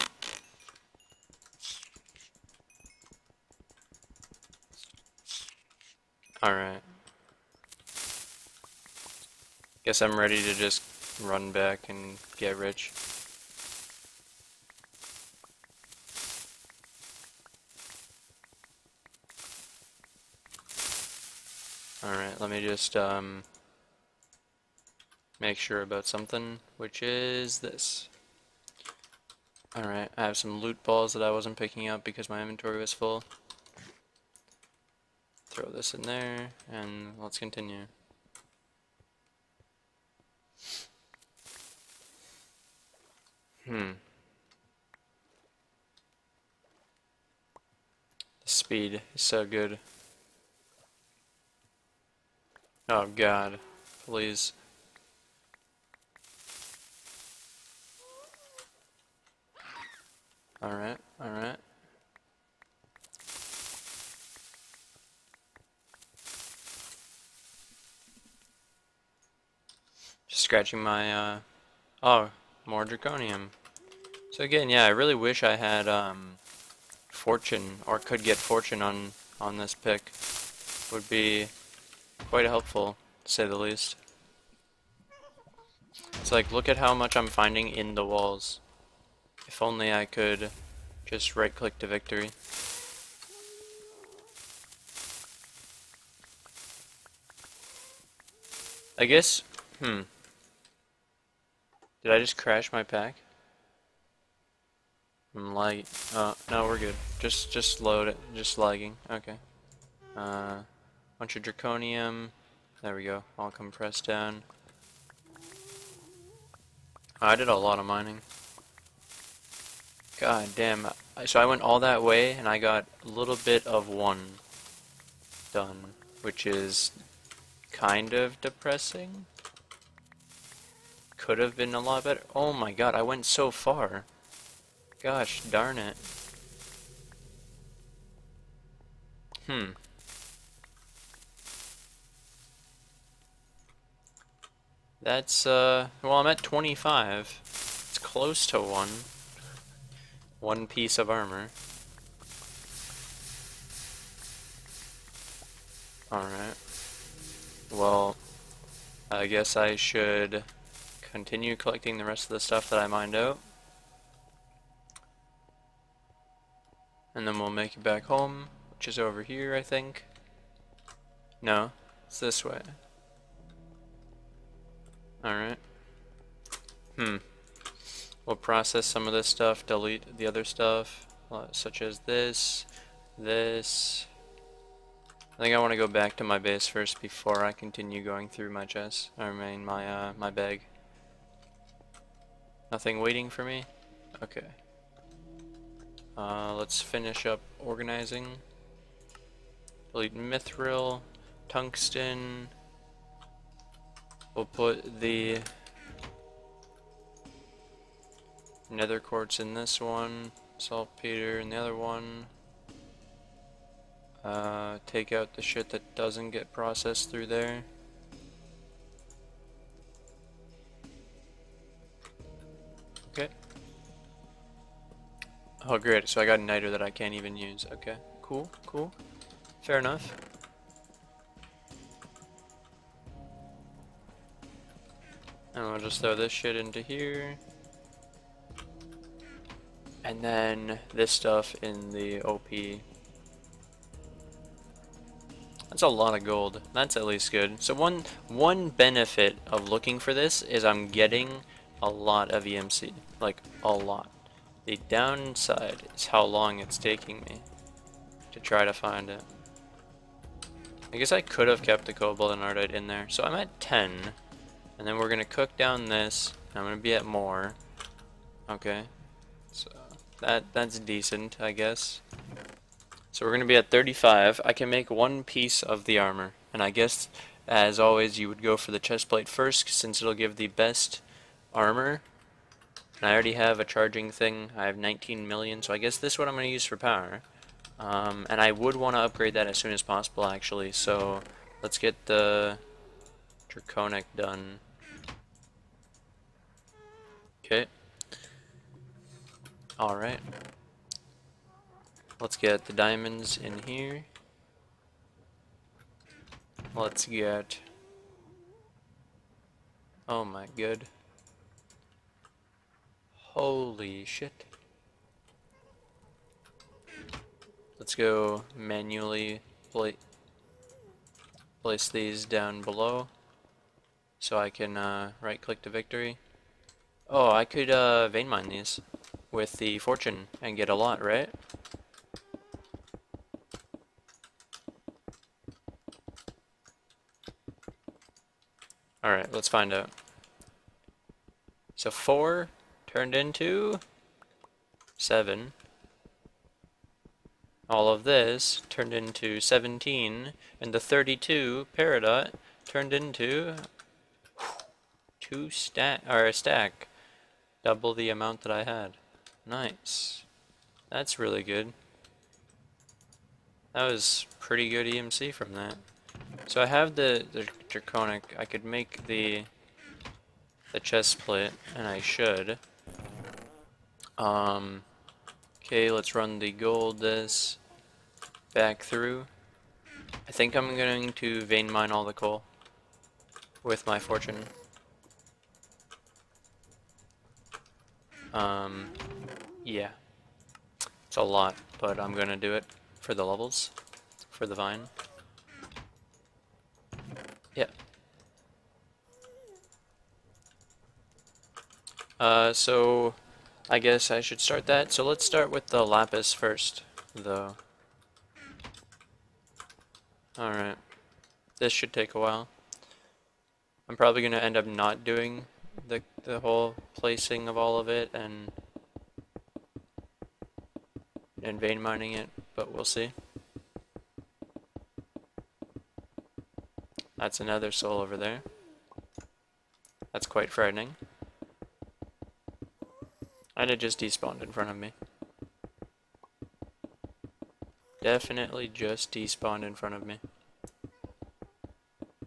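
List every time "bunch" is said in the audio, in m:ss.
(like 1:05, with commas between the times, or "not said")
1:51.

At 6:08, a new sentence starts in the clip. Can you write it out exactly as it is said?
I could make the the chest plate, and I should.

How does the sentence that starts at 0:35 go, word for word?
Throw this in there, and let's continue.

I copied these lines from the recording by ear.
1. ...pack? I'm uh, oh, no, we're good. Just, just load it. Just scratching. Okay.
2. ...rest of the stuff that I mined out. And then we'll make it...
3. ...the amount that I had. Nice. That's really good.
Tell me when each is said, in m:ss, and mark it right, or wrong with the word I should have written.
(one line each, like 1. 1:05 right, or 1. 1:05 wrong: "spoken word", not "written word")
1. 1:42 wrong: "lagging", not "scratching"
2. 2:42 right
3. 5:57 right.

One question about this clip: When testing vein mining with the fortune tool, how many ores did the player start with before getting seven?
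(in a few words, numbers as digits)
4.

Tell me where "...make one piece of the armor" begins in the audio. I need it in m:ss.
4:34.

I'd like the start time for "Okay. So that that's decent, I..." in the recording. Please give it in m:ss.
4:28.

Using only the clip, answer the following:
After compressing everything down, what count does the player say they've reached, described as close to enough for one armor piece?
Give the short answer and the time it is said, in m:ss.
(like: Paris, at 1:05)
25, at 2:26.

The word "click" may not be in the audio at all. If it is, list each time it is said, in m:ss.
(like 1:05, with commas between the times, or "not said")
1:31, 5:25.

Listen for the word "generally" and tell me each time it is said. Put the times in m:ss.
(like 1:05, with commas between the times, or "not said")
not said.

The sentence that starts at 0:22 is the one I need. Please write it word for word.
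Alright, let me just um, make sure about something, which is this.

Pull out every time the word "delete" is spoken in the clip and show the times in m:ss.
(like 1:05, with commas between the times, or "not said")
2:59, 3:19.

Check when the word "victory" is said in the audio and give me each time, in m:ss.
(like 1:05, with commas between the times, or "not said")
1:31, 5:25.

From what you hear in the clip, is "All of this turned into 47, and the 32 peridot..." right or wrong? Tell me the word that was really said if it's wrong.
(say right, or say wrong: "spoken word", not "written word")
wrong: "17", not "47".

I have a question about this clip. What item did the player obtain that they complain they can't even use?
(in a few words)
Niter.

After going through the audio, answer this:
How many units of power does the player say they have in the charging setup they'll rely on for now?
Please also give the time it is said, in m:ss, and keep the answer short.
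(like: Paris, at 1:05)
19 million, at 4:44.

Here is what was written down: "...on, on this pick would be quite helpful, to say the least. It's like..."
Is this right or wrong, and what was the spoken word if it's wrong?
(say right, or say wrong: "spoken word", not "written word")
right.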